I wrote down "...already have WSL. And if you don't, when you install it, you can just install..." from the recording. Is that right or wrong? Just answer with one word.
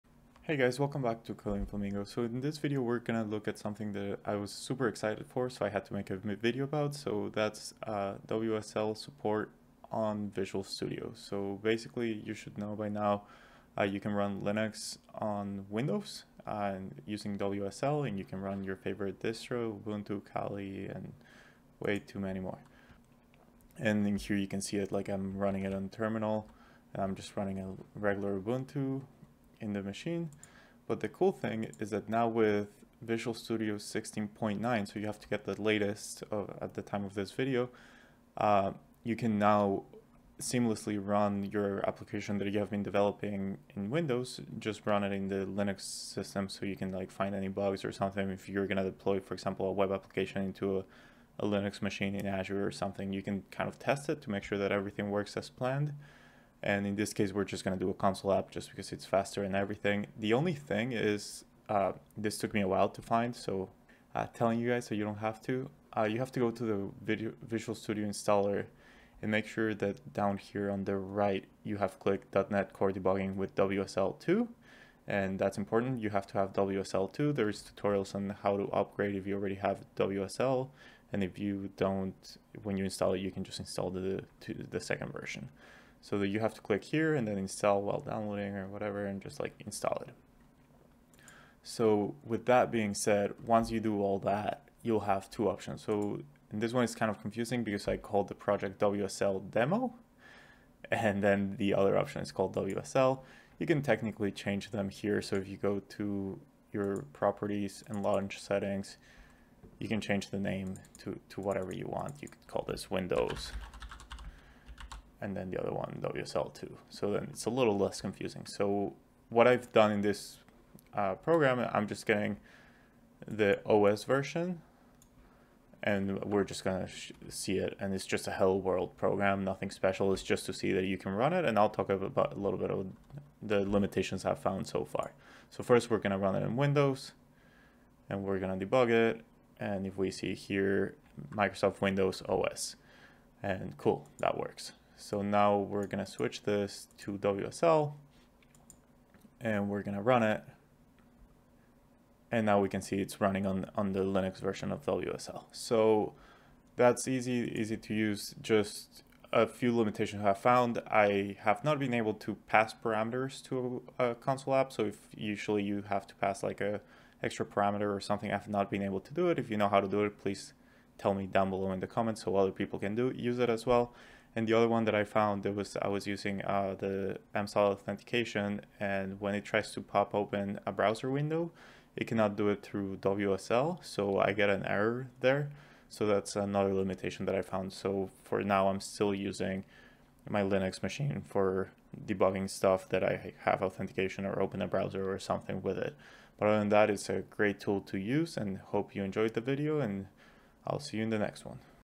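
right.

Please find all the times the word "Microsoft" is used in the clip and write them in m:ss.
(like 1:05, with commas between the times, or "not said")
2:21.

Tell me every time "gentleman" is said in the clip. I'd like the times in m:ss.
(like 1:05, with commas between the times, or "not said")
not said.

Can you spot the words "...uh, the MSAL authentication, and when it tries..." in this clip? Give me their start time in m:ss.
2:56.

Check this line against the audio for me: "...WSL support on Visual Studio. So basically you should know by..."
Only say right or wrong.
right.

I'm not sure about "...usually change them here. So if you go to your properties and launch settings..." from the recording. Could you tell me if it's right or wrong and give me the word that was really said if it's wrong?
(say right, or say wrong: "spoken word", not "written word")
wrong: "technically", not "usually".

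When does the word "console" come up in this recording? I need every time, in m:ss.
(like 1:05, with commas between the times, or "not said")
0:57, 2:44.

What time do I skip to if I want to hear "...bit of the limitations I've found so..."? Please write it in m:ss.
2:12.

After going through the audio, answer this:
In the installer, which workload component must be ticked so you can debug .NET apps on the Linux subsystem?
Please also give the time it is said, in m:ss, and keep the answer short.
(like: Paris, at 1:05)
.NET Core Debugging with WSL2, at 1:12.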